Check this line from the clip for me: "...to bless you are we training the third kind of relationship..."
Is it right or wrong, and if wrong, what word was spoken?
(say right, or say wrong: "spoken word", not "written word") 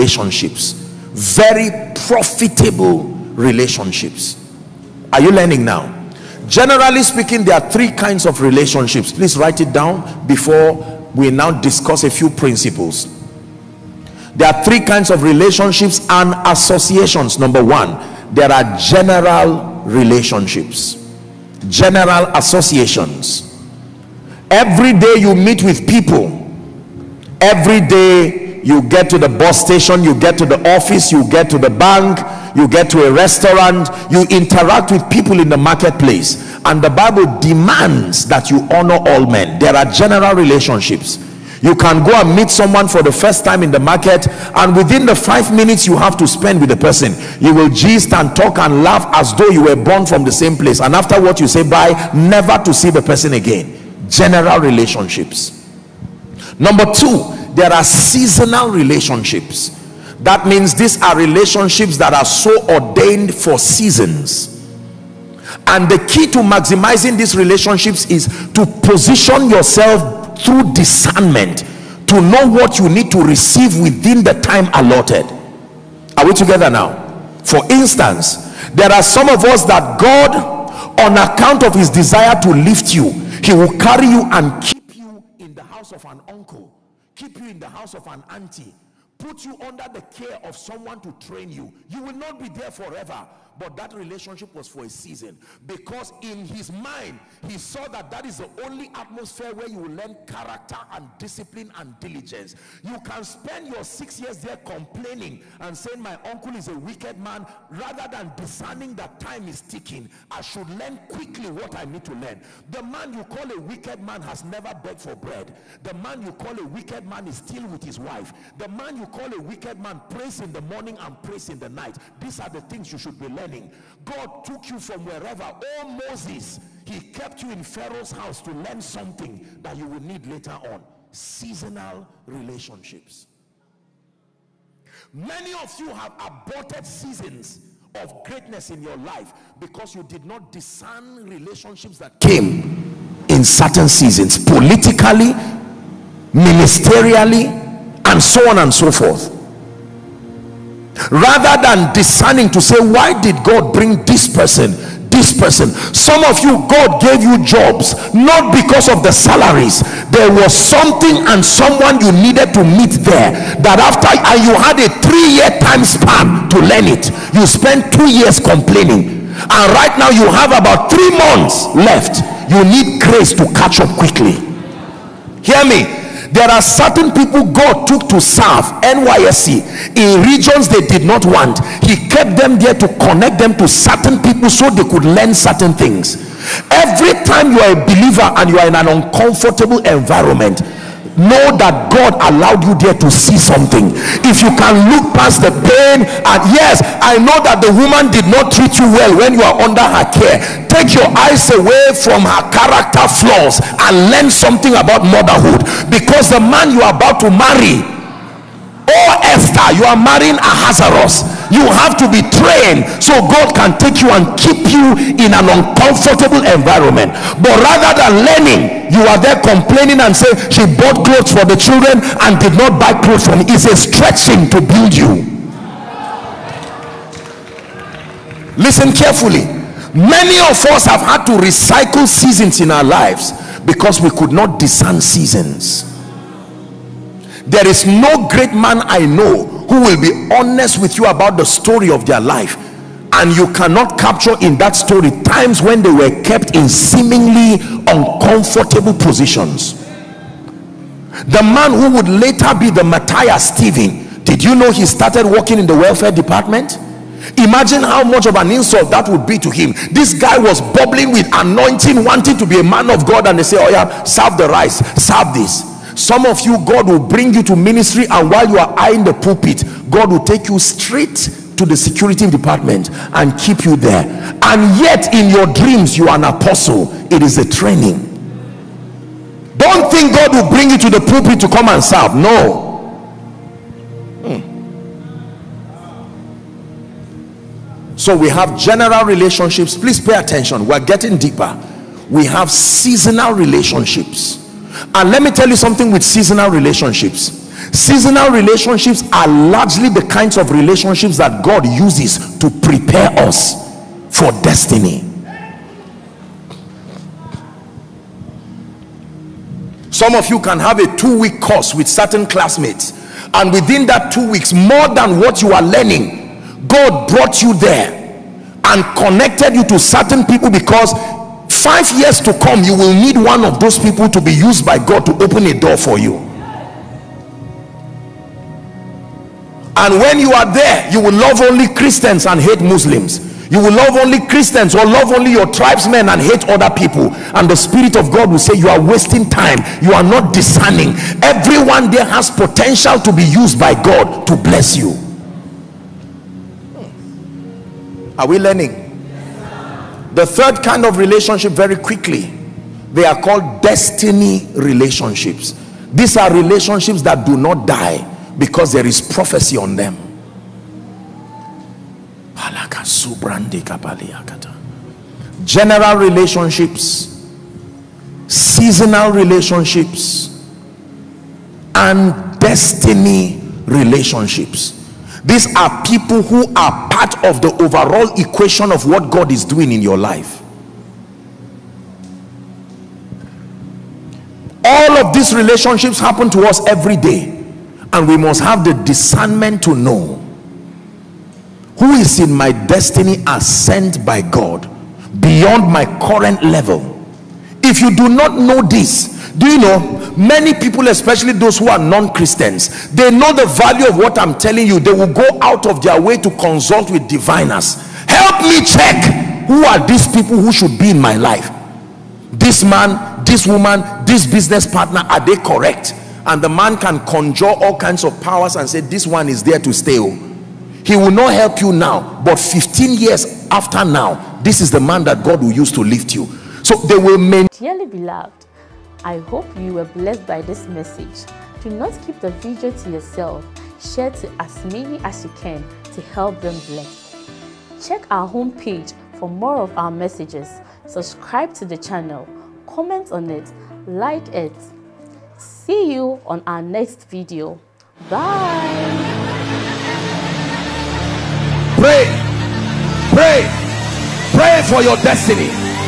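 wrong: "learning", not "training".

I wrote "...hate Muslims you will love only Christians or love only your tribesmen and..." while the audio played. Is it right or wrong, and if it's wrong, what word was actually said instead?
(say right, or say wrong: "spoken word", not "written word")
right.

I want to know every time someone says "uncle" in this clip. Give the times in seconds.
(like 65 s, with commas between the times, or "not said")
86 s, 106 s.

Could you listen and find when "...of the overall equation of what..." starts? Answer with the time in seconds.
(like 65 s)
377 s.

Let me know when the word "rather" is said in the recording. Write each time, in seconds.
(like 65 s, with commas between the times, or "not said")
107 s, 151 s, 217 s.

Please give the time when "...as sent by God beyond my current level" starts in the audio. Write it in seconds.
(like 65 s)
393 s.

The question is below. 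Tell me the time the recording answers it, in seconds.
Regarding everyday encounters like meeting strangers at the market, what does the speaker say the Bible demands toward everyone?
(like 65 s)
38 s.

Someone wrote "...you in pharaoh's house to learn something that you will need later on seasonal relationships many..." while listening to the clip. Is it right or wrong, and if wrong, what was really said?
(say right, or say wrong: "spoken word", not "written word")
right.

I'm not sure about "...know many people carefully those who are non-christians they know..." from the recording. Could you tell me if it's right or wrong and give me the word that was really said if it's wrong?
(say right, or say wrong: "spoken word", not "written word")
wrong: "especially", not "carefully".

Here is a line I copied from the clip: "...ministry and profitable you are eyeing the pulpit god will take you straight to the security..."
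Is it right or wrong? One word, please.
wrong.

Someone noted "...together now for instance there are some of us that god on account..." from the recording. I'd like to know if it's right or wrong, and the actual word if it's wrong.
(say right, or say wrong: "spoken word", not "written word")
right.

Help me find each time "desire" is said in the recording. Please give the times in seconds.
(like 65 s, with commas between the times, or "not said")
81 s.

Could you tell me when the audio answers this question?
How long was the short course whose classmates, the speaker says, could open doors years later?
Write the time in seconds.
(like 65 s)
310 s.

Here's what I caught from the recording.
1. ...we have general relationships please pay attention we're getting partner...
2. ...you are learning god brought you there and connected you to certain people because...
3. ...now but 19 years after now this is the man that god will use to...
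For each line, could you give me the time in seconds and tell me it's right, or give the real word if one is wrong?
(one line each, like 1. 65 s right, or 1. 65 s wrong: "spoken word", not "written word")
1. 288 s wrong: "deeper", not "partner"
2. 315 s right
3. 421 s wrong: "15", not "19".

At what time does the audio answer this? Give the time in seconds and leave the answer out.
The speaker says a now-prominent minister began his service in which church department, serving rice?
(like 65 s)
255 s.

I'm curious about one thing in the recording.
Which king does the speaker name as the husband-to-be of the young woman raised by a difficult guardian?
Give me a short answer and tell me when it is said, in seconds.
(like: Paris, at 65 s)
Ahasuerus, at 210 s.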